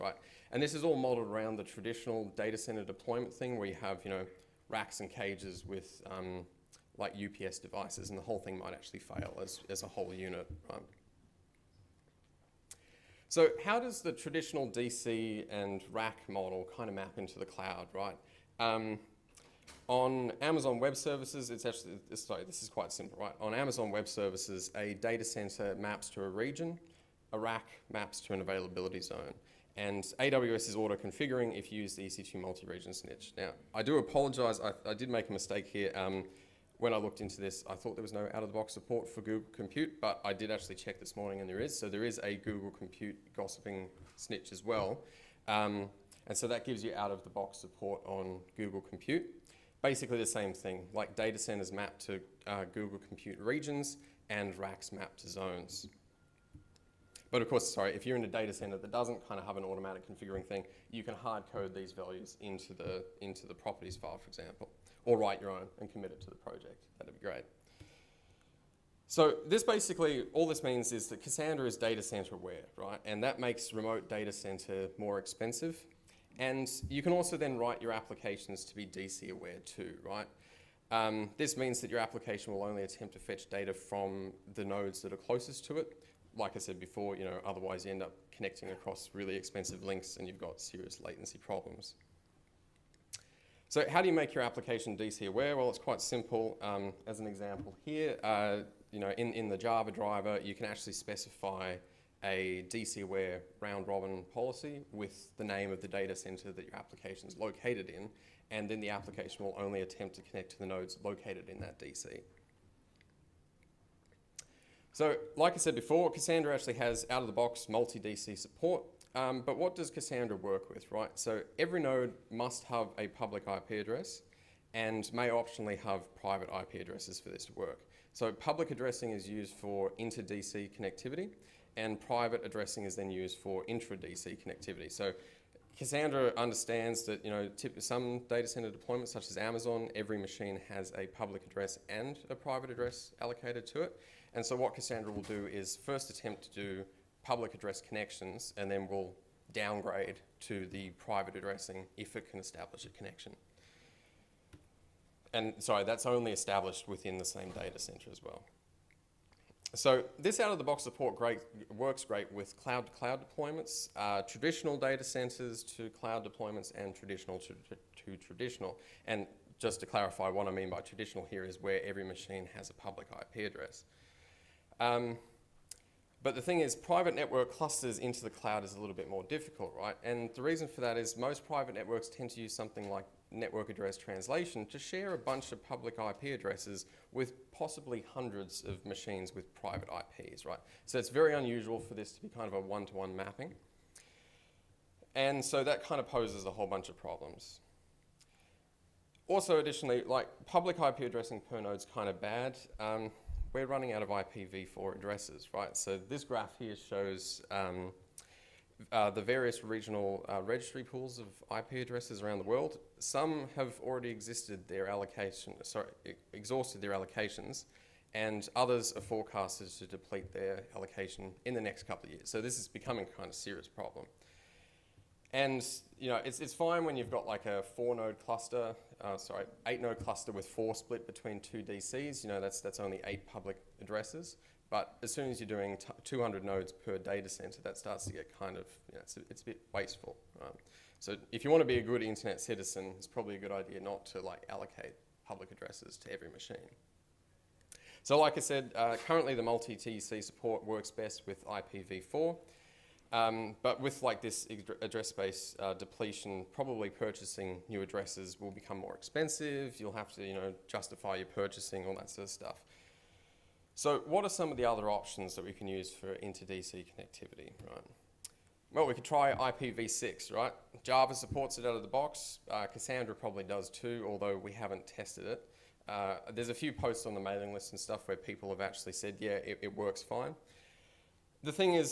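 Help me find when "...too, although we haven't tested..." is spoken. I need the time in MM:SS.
04:33.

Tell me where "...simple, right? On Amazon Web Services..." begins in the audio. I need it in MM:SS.
00:22.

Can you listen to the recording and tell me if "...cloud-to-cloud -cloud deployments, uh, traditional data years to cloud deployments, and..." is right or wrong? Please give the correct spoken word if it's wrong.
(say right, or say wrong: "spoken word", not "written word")
wrong: "centers", not "years".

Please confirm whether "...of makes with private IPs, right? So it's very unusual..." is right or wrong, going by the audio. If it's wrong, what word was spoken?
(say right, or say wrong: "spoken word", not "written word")
wrong: "machines", not "makes".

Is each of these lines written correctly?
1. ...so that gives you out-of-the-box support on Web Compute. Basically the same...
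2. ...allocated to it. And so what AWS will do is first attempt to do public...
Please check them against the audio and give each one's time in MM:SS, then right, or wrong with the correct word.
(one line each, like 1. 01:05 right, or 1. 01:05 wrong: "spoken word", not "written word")
1. 00:46 wrong: "Google", not "Web"
2. 02:23 wrong: "Cassandra", not "AWS".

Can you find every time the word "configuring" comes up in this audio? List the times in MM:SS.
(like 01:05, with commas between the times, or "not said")
00:30, 01:00.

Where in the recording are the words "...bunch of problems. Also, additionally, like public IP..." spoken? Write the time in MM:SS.
03:16.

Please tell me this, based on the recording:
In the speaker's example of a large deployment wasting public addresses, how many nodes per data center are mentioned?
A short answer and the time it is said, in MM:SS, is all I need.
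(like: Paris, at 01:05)
200, at 03:56.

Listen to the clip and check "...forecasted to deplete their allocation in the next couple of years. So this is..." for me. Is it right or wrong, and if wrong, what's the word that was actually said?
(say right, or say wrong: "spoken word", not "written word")
right.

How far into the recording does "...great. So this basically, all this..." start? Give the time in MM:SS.
01:07.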